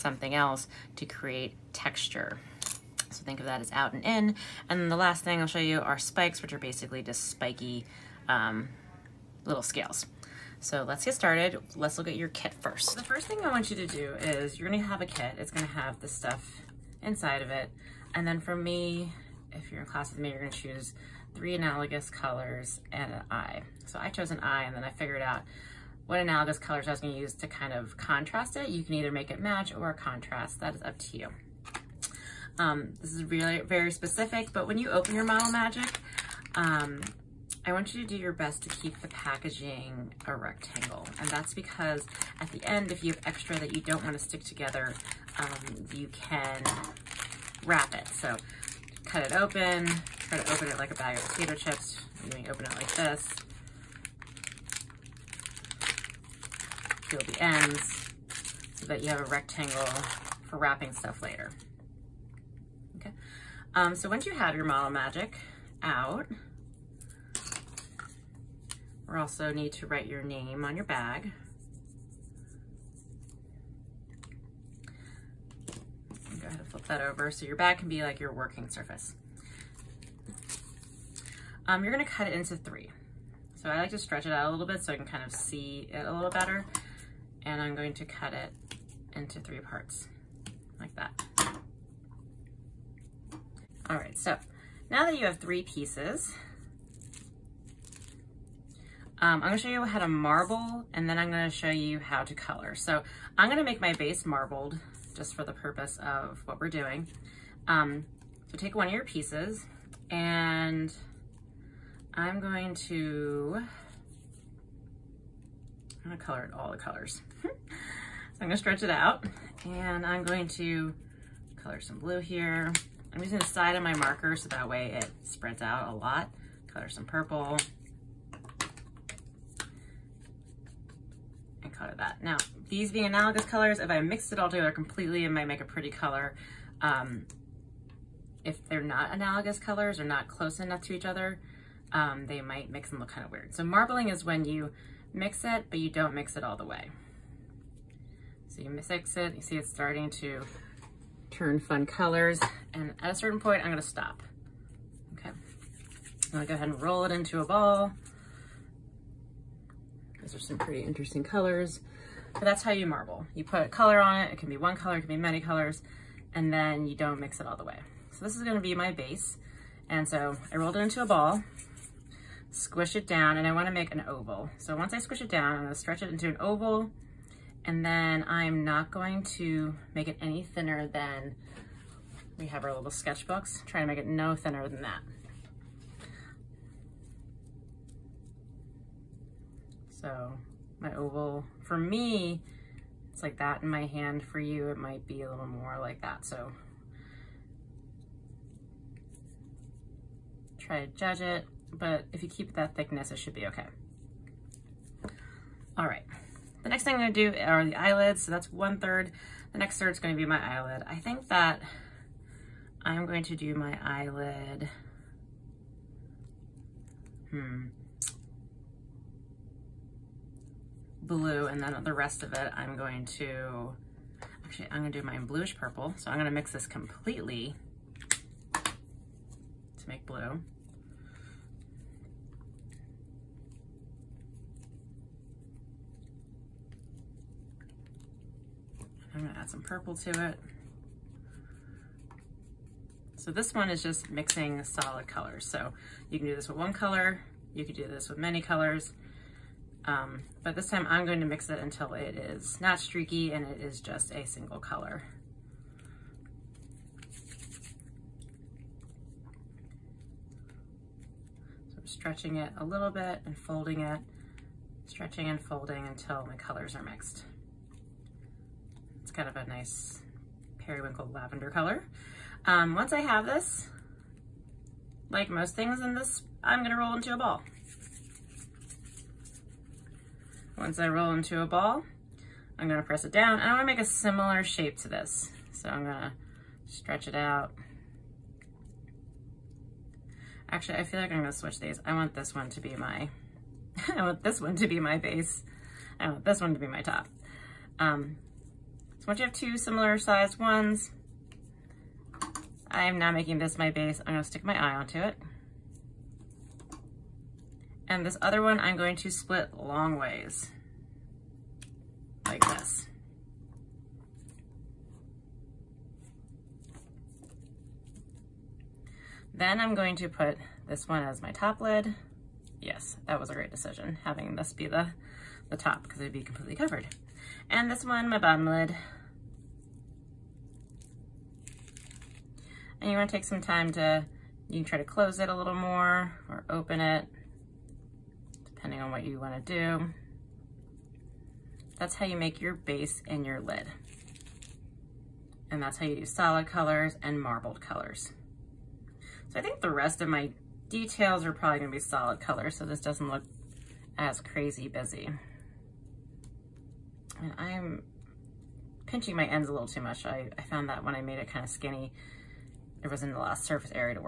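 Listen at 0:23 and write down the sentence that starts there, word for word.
So I chose an eye and then I figured out what analogous colors I was gonna use to kind of contrast it.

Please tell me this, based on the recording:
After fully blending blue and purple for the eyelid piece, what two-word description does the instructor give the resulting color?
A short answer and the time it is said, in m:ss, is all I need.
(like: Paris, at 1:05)
Periwinkle lavender, at 4:30.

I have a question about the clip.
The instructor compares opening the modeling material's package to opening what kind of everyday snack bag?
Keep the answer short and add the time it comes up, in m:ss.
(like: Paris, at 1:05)
Bag of potato chips, at 0:50.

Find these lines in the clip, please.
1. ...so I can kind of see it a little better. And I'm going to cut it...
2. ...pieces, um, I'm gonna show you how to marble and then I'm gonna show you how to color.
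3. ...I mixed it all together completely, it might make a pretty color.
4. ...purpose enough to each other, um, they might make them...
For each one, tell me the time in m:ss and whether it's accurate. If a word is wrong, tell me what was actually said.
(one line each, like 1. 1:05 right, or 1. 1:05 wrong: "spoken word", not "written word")
1. 1:24 right
2. 1:35 right
3. 2:13 right
4. 2:20 wrong: "close", not "purpose".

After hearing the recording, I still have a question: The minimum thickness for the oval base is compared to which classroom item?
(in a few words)
Sketchbooks.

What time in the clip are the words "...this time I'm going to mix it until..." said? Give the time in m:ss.
4:10.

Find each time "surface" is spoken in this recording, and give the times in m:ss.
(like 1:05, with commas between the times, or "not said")
1:18, 6:03.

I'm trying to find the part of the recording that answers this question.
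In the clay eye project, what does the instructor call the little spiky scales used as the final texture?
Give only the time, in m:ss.
0:05.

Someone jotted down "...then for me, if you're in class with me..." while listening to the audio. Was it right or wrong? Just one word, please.
right.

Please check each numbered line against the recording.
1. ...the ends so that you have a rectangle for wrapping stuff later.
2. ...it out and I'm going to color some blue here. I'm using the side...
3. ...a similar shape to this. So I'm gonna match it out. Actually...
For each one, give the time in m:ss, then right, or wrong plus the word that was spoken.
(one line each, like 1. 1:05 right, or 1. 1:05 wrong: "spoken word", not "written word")
1. 0:57 right
2. 1:58 right
3. 4:43 wrong: "stretch", not "match".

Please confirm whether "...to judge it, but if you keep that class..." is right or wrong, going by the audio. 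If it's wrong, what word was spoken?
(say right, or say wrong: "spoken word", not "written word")
wrong: "thickness", not "class".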